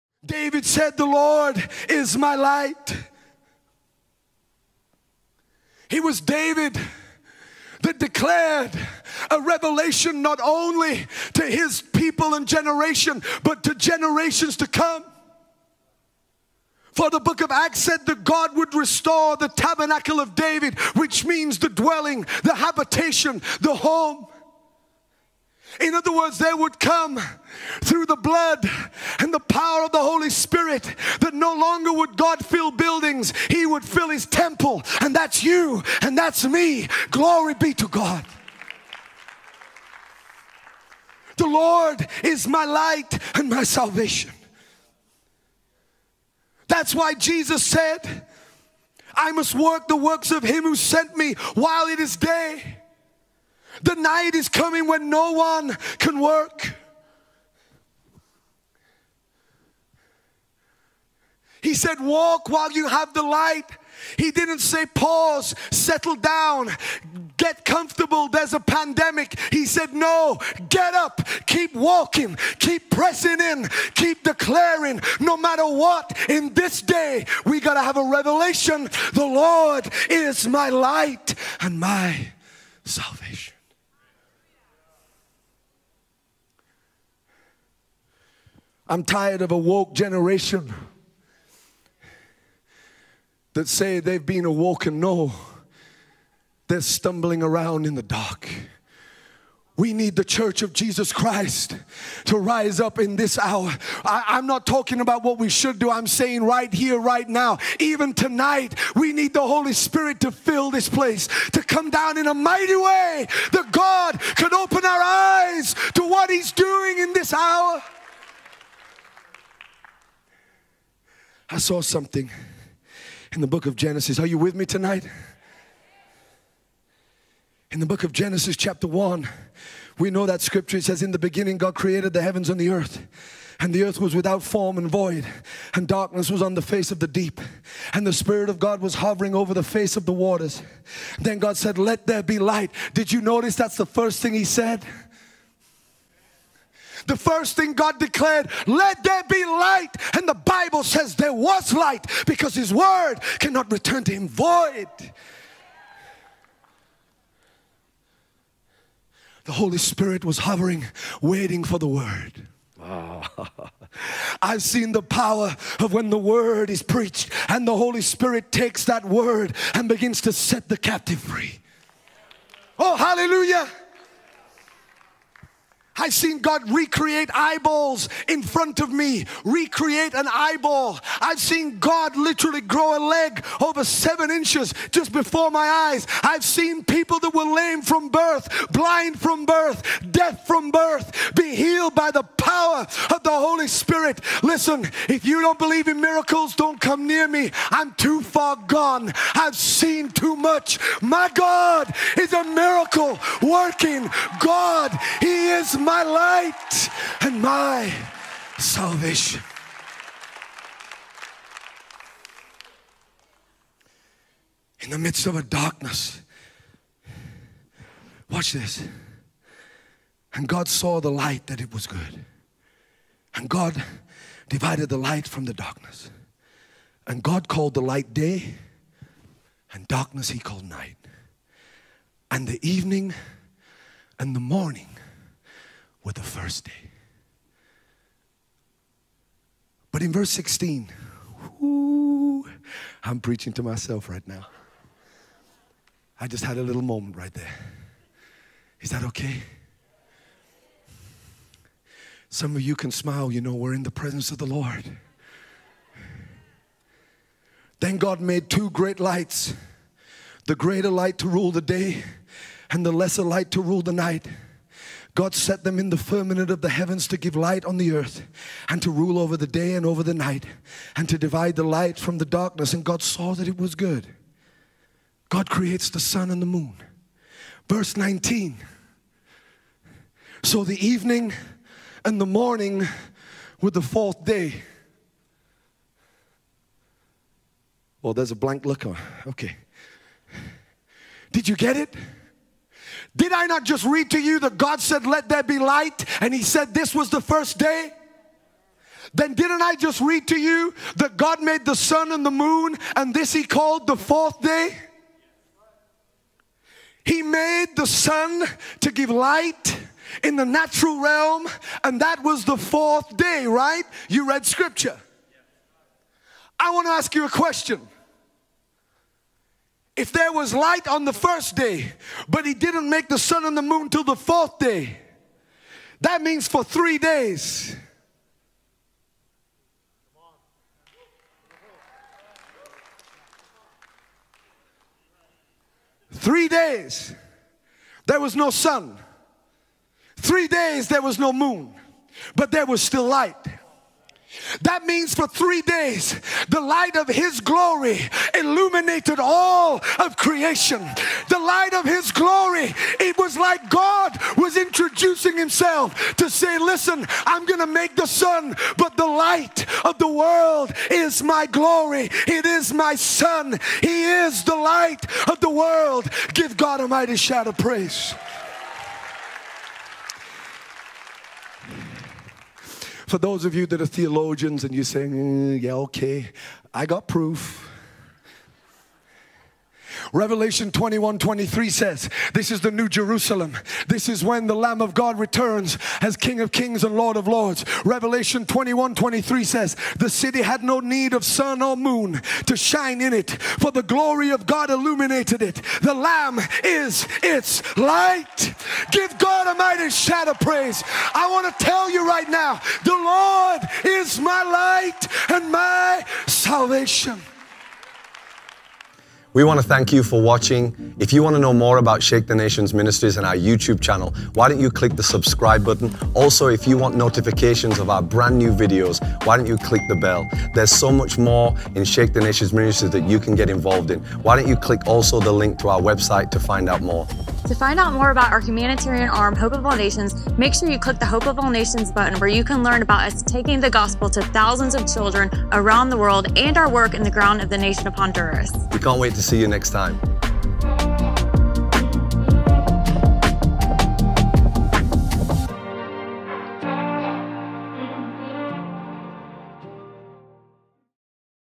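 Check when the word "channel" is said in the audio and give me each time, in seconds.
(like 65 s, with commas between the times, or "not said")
413 s.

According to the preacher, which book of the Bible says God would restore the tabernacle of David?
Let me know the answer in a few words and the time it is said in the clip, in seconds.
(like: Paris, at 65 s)
Acts, at 17 s.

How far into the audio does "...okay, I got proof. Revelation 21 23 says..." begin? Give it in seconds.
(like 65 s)
375 s.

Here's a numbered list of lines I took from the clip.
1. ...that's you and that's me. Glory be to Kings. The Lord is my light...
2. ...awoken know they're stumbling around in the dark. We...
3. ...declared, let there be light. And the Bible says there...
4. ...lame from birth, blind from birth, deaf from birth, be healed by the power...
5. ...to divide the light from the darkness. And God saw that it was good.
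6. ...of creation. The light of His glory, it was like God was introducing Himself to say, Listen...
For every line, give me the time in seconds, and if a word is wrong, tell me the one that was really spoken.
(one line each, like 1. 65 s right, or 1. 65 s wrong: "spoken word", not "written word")
1. 35 s wrong: "God", not "Kings"
2. 94 s right
3. 147 s right
4. 187 s right
5. 271 s right
6. 349 s right.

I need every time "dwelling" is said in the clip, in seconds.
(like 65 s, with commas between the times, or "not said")
21 s.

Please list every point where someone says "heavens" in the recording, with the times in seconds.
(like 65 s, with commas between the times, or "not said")
132 s, 266 s.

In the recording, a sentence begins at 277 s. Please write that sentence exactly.
Verse 19 So the evening and the morning were the fourth day.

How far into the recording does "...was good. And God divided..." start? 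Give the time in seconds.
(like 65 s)
221 s.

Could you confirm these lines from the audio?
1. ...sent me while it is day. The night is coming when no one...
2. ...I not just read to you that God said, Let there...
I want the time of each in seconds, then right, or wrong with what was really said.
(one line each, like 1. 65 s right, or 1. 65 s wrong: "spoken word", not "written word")
1. 50 s right
2. 293 s right.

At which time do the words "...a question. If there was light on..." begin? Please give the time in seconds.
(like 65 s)
317 s.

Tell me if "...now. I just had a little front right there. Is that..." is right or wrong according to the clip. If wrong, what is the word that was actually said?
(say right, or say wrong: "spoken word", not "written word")
wrong: "moment", not "front".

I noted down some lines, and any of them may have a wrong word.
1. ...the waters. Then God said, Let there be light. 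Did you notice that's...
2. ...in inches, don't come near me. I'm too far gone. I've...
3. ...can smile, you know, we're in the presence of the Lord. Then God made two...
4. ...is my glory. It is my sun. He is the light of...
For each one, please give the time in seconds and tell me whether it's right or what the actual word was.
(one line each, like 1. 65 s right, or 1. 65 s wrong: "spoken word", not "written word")
1. 140 s right
2. 195 s wrong: "miracles", not "inches"
3. 252 s right
4. 360 s right.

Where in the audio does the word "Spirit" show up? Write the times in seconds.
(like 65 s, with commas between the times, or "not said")
30 s, 109 s, 138 s, 159 s, 168 s, 193 s.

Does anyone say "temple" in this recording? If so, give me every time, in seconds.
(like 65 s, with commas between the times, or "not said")
34 s.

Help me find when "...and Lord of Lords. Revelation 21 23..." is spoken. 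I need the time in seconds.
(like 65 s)
386 s.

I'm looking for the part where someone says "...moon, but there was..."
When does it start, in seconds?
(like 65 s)
341 s.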